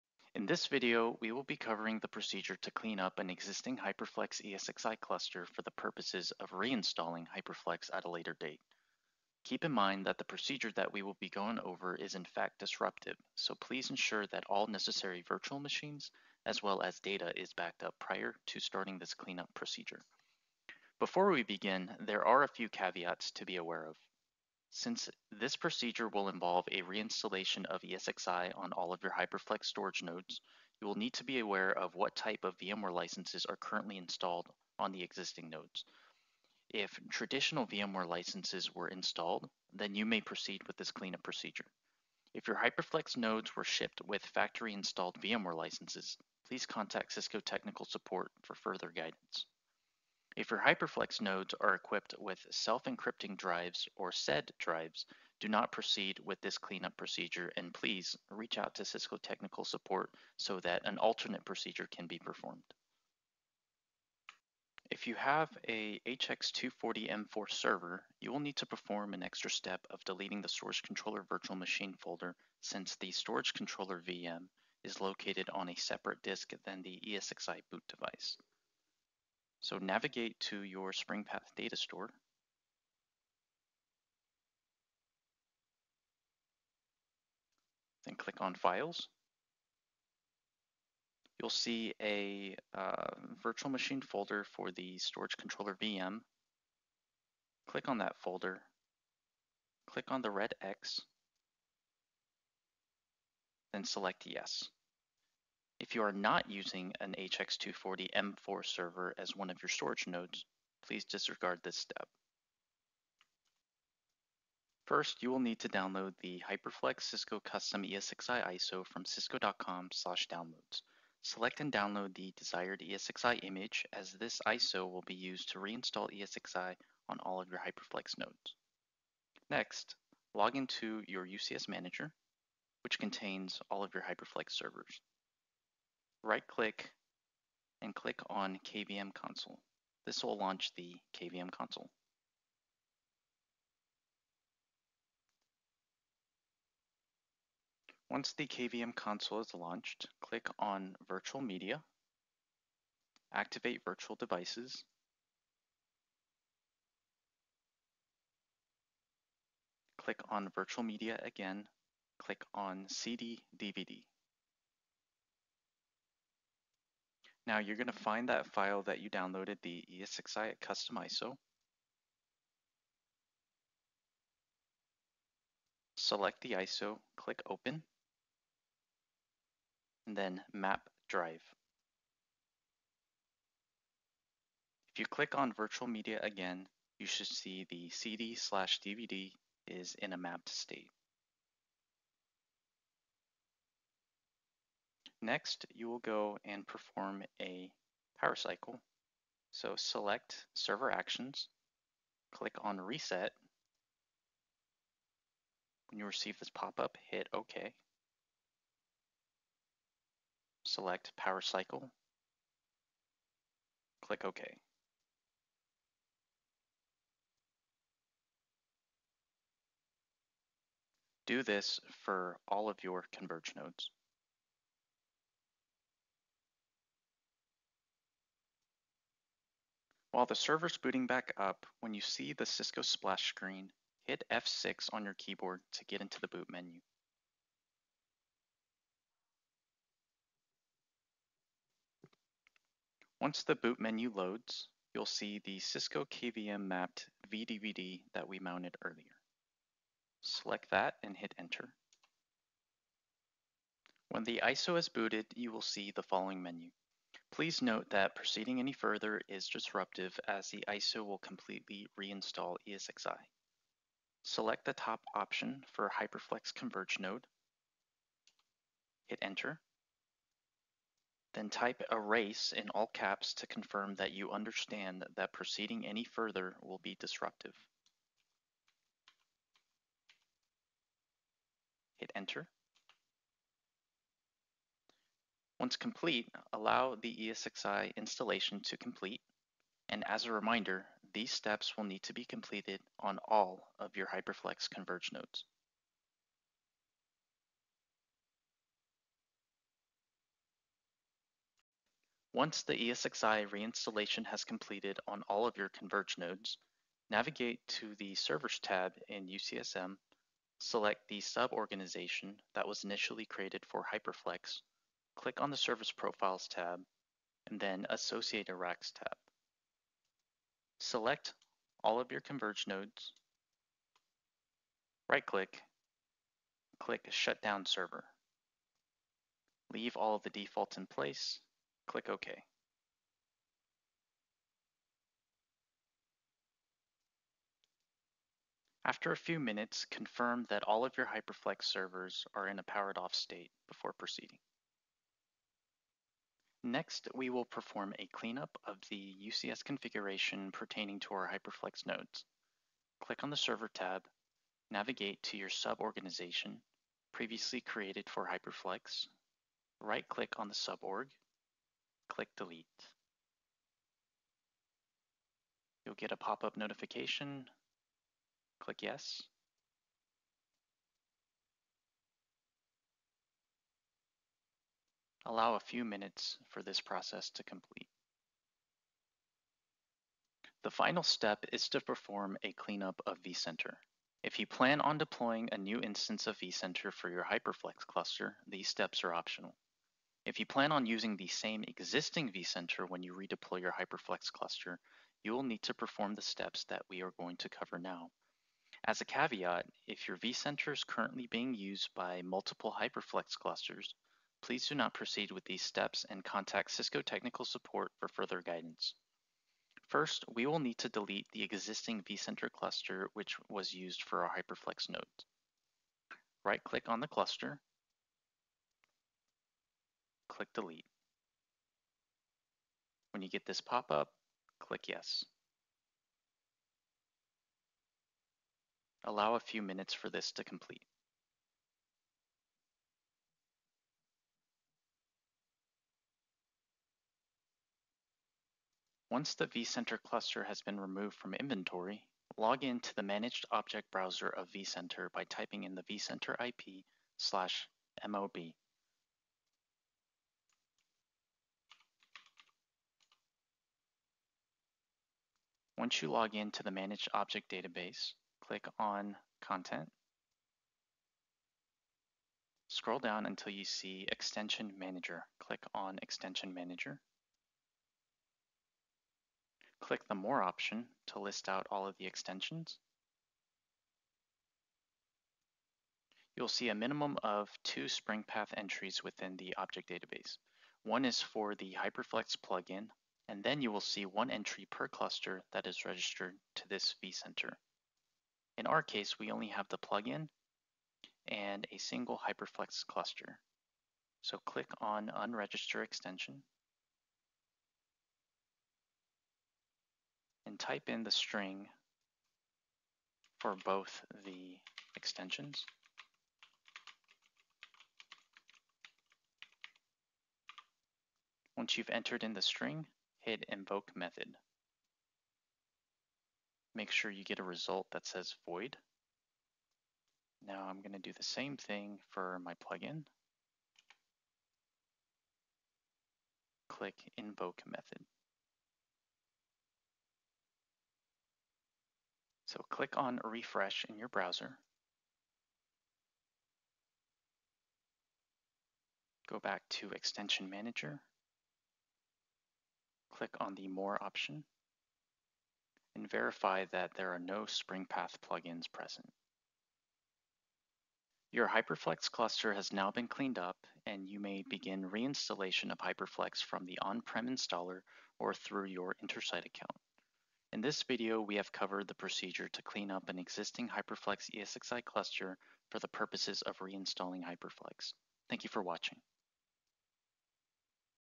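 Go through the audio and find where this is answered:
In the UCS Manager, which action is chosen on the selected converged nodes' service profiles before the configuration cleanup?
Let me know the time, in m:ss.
5:27.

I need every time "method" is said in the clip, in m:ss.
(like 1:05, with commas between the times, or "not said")
8:33, 8:47.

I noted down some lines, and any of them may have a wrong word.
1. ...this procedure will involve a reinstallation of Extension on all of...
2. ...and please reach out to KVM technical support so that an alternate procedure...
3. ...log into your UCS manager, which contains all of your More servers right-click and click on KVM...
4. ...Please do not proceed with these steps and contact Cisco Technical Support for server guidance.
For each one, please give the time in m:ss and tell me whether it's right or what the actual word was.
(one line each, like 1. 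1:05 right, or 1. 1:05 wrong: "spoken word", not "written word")
1. 0:25 wrong: "ESXi", not "Extension"
2. 0:57 wrong: "Cisco", not "KVM"
3. 2:10 wrong: "HyperFlex", not "More"
4. 6:44 wrong: "further", not "server".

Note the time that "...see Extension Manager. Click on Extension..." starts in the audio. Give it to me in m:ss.
7:43.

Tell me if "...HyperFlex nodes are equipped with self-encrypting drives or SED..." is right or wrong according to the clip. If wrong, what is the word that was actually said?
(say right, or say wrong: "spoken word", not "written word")
right.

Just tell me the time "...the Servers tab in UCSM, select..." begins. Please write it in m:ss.
5:07.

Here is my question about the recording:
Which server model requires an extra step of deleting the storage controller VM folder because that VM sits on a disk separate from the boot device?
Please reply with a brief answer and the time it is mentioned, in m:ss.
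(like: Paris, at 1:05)
HX240 M4, at 1:06.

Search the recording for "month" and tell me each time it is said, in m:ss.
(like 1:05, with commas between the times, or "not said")
not said.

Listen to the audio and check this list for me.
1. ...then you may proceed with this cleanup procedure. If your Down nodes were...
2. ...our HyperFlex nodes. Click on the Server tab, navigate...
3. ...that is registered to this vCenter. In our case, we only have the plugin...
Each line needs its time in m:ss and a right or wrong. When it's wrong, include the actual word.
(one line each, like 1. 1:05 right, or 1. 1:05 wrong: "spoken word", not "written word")
1. 0:39 wrong: "HyperFlex", not "Down"
2. 5:51 right
3. 8:05 right.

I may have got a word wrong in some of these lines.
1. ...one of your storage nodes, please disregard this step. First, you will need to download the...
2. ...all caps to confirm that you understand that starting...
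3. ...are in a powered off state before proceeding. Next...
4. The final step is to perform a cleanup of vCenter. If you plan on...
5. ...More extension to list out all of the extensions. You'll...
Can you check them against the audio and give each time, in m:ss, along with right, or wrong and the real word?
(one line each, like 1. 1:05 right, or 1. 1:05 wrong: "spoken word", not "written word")
1. 1:49 right
2. 4:32 wrong: "proceeding", not "starting"
3. 5:42 right
4. 6:20 right
5. 7:50 wrong: "option", not "extension".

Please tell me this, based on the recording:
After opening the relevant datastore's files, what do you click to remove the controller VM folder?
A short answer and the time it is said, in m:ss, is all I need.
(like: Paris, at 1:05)
the red X, at 1:40.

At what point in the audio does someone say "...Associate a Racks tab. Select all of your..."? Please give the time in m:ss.
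5:17.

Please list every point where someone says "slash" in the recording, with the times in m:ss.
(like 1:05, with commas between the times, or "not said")
1:59, 3:08, 7:27.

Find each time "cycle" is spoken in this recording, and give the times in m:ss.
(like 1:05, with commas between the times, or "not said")
3:18, 3:31.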